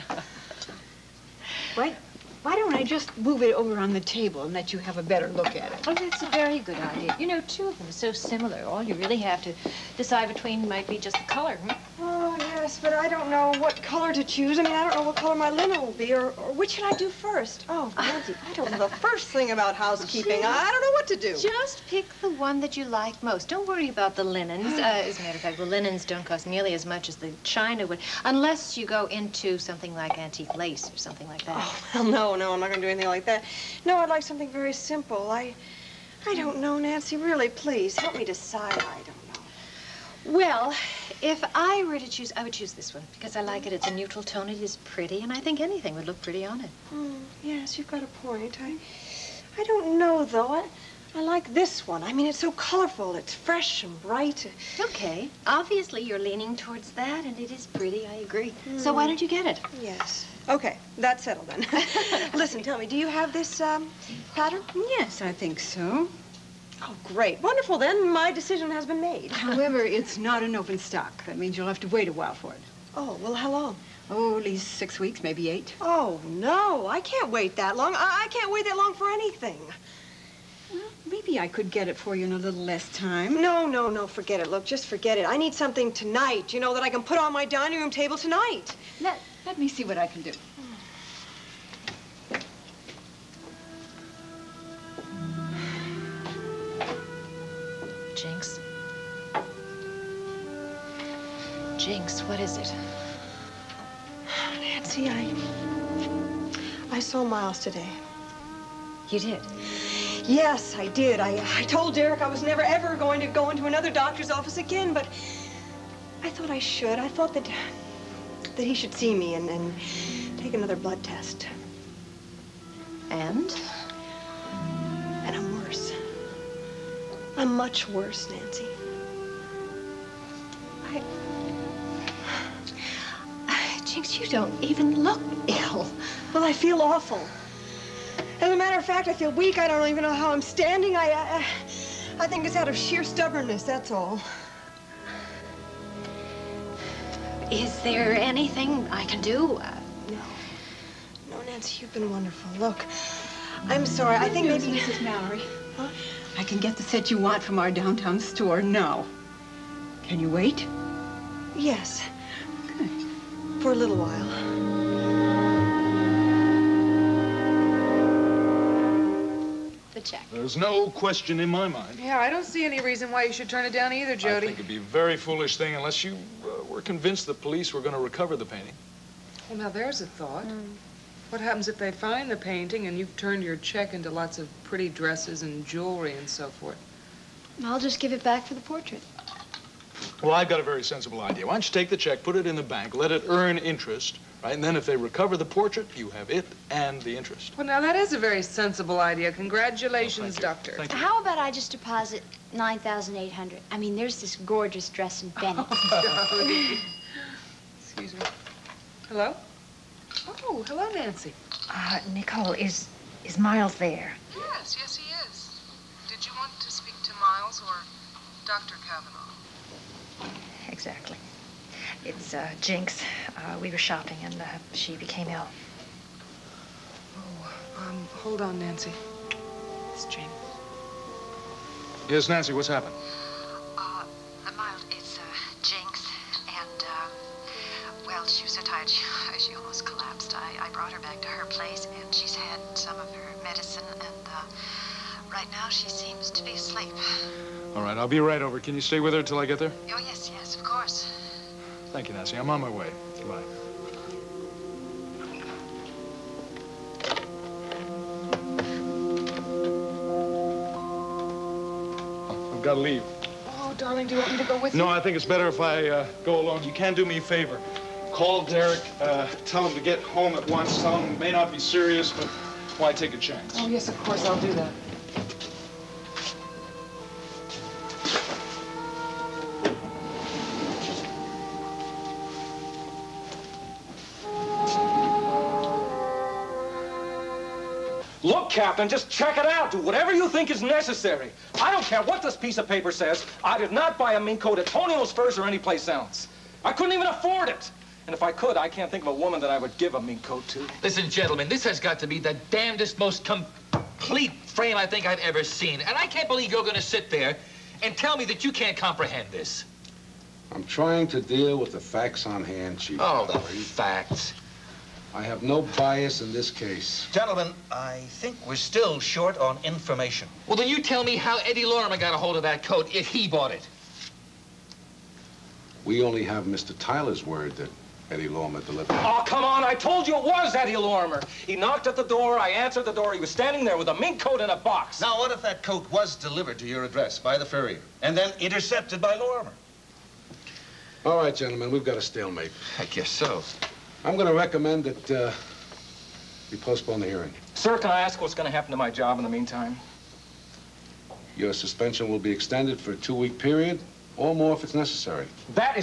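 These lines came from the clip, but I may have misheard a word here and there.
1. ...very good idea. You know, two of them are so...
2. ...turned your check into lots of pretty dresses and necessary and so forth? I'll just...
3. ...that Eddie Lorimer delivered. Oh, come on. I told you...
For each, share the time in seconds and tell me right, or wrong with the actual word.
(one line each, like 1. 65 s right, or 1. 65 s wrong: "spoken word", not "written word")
1. 6 s right
2. 183 s wrong: "jewelry", not "necessary"
3. 327 s right.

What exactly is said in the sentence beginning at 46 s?
Mm, yes, you've got a point.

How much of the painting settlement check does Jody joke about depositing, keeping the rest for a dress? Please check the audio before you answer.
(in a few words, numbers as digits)
9,800.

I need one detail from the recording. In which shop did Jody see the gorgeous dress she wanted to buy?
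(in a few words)
Bennett.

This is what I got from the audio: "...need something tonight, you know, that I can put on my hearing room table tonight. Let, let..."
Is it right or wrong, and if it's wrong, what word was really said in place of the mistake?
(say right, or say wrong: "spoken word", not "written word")
wrong: "dining", not "hearing".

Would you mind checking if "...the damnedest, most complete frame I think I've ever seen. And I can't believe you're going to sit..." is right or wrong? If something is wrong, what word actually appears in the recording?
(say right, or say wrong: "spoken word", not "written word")
right.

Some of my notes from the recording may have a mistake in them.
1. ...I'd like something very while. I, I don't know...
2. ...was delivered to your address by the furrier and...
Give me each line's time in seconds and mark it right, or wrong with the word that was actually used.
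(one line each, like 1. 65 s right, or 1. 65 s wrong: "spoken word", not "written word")
1. 33 s wrong: "simple", not "while"
2. 335 s right.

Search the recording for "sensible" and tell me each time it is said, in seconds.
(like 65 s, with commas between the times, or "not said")
190 s, 198 s.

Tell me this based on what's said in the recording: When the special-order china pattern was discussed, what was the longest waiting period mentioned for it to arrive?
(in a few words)
8 weeks.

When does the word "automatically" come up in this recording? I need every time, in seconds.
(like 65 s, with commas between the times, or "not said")
not said.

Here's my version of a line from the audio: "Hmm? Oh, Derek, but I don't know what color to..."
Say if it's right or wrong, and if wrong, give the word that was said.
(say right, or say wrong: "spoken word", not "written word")
wrong: "Yes", not "Derek".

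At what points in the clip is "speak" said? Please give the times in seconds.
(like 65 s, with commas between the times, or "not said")
216 s.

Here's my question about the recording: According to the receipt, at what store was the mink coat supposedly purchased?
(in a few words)
Tonio's Furs.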